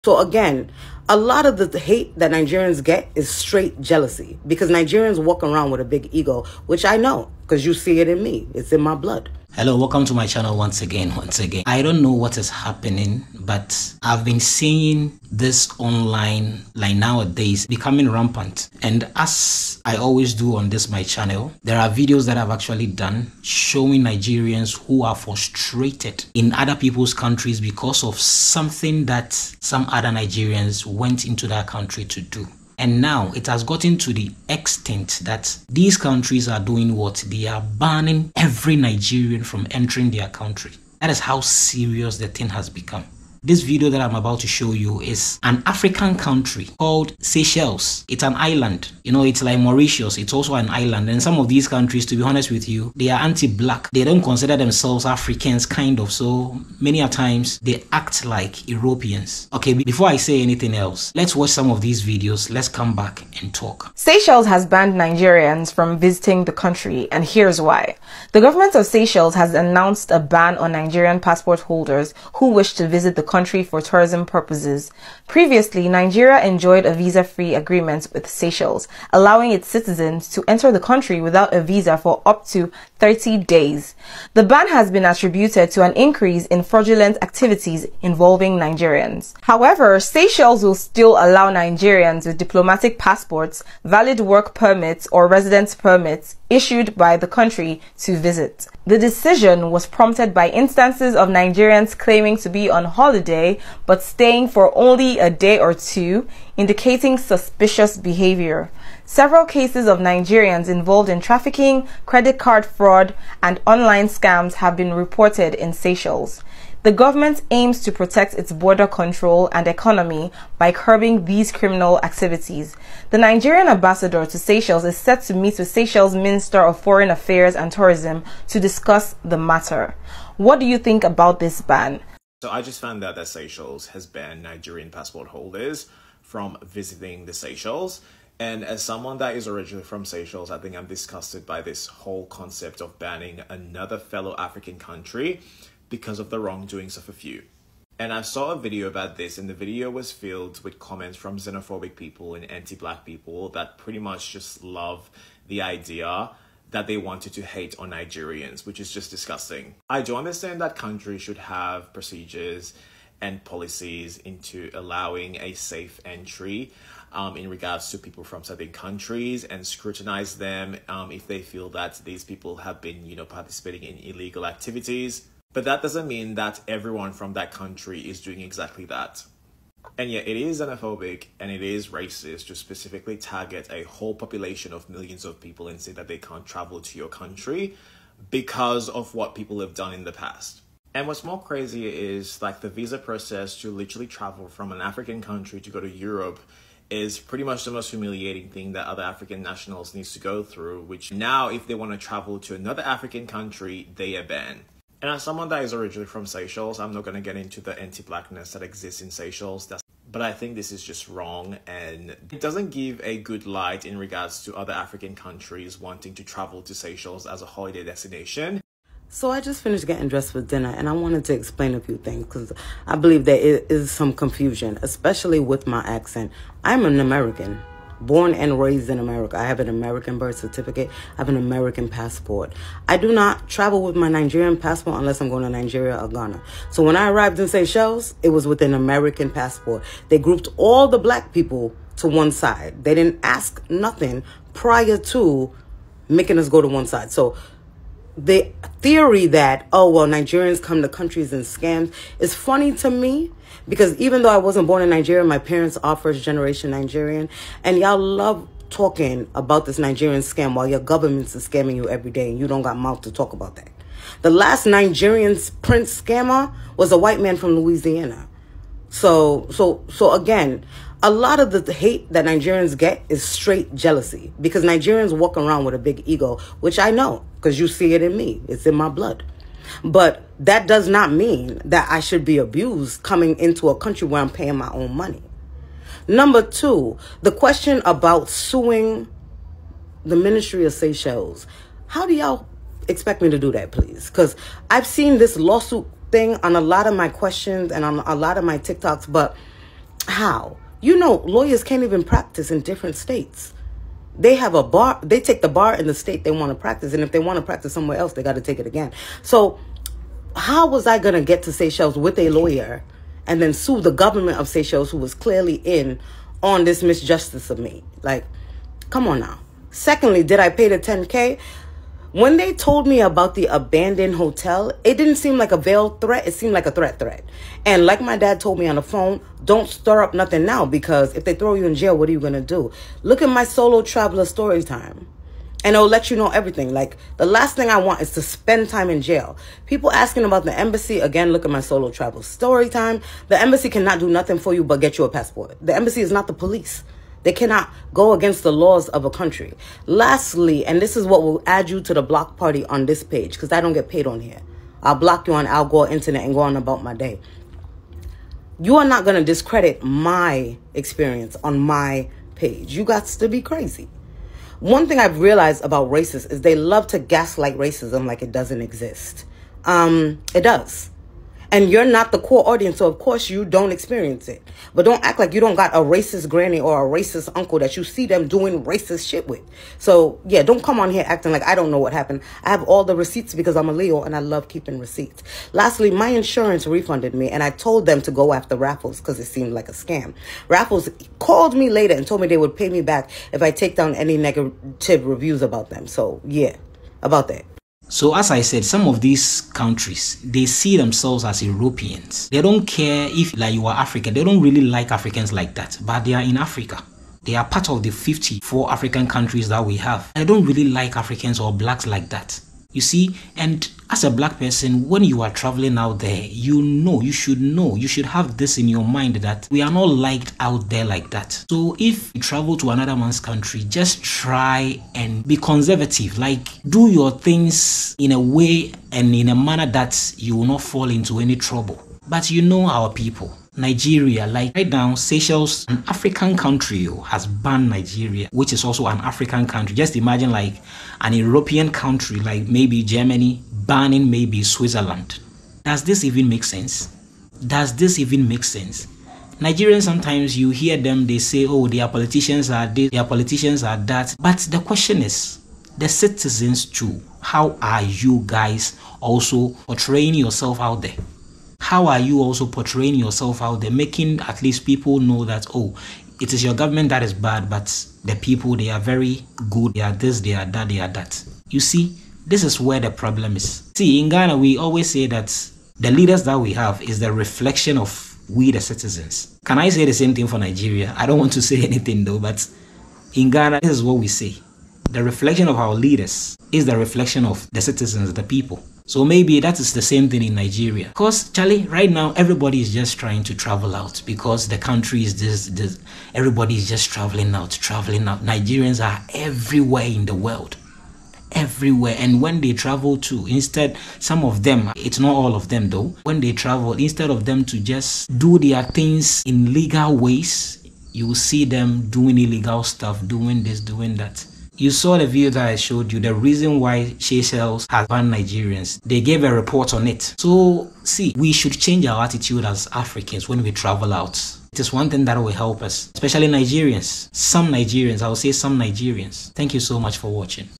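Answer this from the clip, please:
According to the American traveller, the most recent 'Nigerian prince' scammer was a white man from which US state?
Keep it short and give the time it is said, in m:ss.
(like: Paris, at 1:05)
Louisiana, at 4:27.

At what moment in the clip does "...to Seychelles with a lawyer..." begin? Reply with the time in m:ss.
5:11.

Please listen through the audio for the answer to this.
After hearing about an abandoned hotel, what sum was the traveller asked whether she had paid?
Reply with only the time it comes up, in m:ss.
5:20.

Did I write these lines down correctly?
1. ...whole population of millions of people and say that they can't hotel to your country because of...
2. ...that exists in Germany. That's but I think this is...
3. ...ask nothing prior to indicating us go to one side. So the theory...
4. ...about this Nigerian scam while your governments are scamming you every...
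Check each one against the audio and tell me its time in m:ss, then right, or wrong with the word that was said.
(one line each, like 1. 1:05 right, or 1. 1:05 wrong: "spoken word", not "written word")
1. 3:03 wrong: "travel", not "hotel"
2. 3:28 wrong: "Seychelles", not "Germany"
3. 4:03 wrong: "making", not "indicating"
4. 4:19 right.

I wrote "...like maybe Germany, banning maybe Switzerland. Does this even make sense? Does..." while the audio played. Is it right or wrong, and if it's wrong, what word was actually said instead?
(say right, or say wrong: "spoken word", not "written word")
right.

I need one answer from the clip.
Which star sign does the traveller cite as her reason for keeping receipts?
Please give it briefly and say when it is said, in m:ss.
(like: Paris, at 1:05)
Leo, at 6:23.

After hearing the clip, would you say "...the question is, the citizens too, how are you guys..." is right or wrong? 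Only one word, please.
right.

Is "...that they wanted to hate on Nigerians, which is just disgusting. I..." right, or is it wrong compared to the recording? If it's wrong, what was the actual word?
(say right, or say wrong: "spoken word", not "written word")
right.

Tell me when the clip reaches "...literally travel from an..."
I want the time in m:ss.
3:13.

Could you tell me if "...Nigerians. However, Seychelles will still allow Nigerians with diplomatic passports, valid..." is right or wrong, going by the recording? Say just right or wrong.
right.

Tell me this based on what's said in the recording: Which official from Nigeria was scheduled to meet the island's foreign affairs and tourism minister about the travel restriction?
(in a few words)
The Nigerian ambassador.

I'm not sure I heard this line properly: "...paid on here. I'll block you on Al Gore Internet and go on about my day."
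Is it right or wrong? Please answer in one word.
right.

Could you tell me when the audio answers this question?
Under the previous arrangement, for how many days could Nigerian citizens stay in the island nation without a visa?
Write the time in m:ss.
1:23.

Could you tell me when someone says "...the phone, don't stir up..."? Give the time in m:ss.
5:28.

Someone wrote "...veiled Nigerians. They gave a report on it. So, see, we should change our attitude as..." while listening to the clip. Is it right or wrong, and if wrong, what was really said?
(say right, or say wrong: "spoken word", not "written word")
wrong: "banned", not "veiled".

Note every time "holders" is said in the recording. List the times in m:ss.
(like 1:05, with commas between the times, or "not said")
1:11, 2:15.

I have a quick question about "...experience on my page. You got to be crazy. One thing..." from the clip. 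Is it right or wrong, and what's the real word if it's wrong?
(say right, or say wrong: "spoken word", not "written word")
right.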